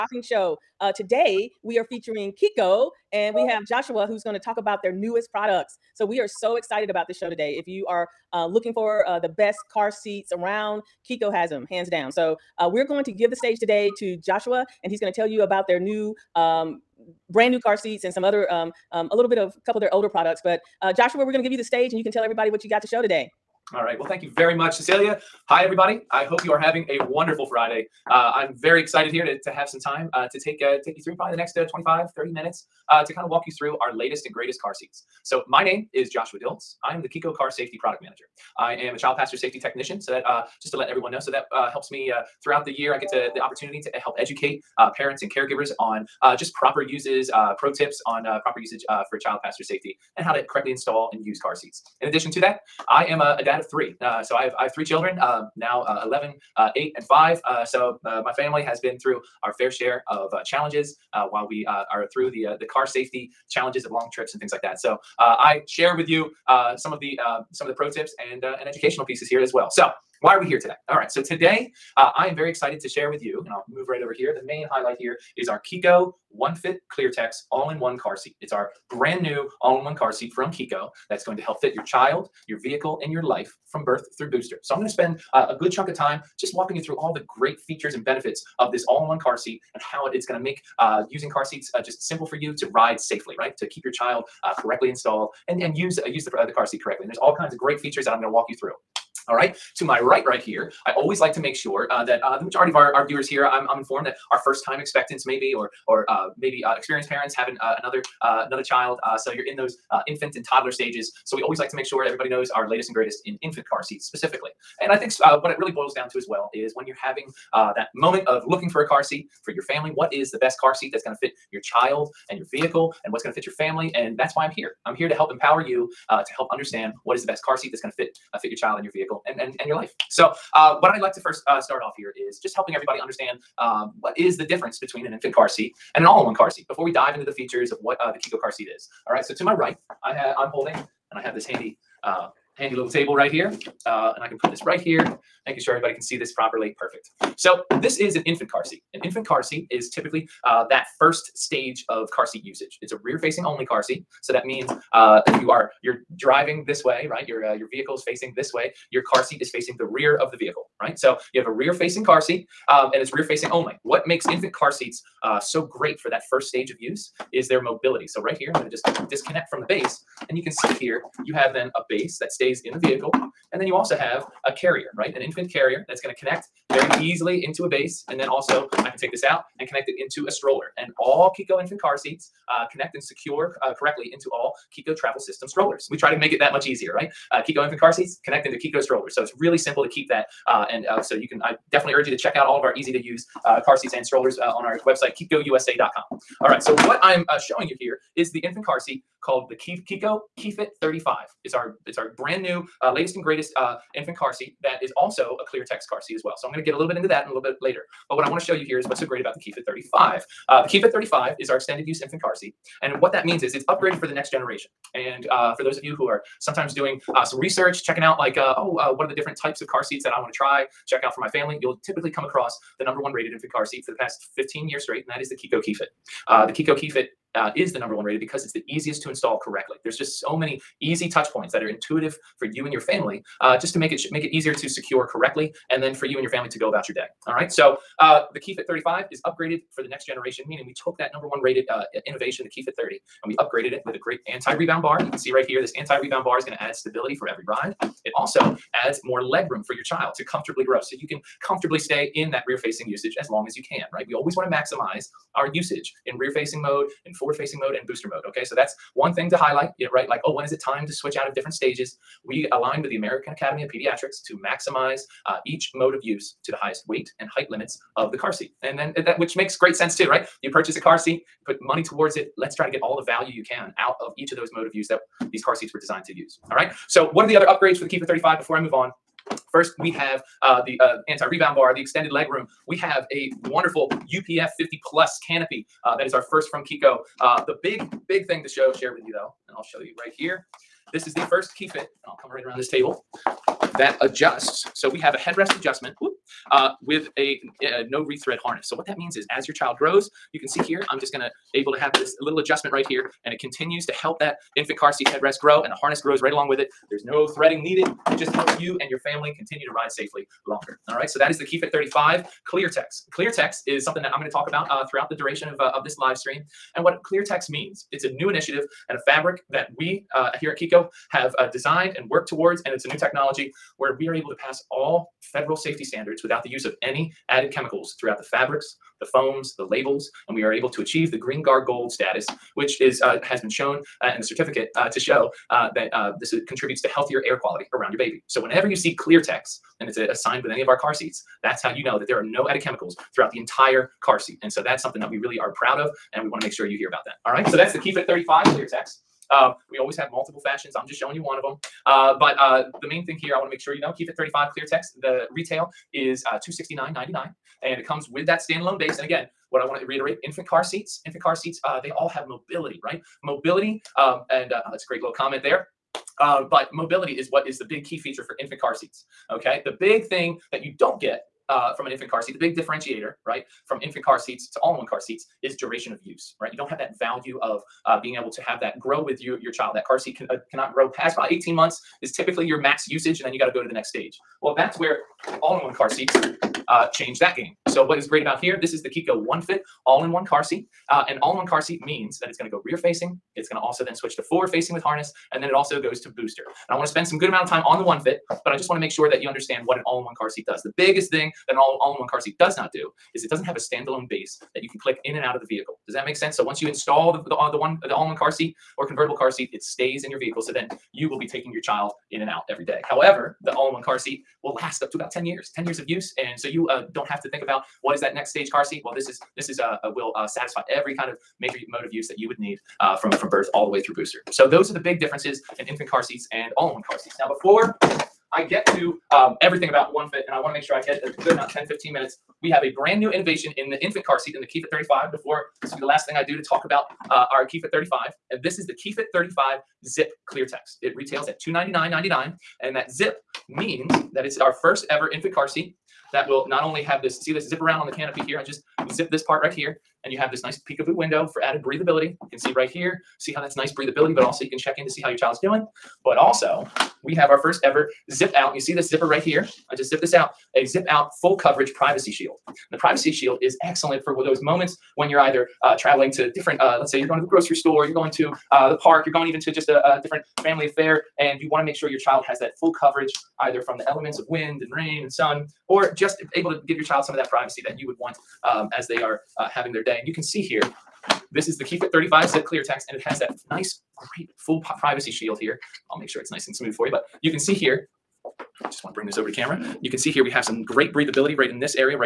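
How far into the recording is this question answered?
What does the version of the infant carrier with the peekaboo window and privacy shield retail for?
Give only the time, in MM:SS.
07:21.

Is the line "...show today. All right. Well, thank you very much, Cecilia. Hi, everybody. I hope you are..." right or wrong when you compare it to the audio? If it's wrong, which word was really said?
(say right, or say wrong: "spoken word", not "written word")
right.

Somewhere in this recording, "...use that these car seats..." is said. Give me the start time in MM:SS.
04:34.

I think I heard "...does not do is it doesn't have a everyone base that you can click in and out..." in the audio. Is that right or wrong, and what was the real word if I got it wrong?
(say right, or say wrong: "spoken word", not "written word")
wrong: "standalone", not "everyone".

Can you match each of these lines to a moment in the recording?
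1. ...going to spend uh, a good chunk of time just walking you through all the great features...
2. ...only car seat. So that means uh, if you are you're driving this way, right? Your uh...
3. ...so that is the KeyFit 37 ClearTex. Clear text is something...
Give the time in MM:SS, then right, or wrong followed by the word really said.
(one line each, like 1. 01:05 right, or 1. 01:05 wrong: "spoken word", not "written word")
1. 01:24 right
2. 02:33 right
3. 05:11 wrong: "35", not "37".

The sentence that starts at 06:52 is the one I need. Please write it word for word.
However, the all-in-one car seat will last up to about 10 years, 10 years of use.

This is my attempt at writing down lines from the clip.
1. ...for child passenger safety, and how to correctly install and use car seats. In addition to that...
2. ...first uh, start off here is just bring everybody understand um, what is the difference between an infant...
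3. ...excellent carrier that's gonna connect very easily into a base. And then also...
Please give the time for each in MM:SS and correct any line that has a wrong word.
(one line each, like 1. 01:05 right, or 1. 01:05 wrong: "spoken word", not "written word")
1. 00:49 right
2. 02:11 wrong: "helping", not "bring"
3. 02:55 wrong: "infant", not "excellent".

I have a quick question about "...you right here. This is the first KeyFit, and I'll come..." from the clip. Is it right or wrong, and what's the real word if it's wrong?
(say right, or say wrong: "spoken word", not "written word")
right.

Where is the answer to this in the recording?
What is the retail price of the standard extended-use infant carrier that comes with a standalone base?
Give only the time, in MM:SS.
05:56.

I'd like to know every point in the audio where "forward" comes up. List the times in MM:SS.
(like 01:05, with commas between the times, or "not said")
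04:17, 06:34.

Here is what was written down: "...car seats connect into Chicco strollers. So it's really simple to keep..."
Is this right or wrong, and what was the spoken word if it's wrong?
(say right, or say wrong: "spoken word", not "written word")
right.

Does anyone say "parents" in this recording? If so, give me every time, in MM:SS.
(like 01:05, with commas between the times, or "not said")
00:44, 01:47.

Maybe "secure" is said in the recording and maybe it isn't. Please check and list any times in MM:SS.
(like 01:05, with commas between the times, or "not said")
03:03, 03:54.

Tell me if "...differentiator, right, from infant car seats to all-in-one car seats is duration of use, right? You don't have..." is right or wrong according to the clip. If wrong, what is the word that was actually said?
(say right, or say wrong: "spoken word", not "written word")
right.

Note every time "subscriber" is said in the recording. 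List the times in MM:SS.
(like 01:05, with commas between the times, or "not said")
not said.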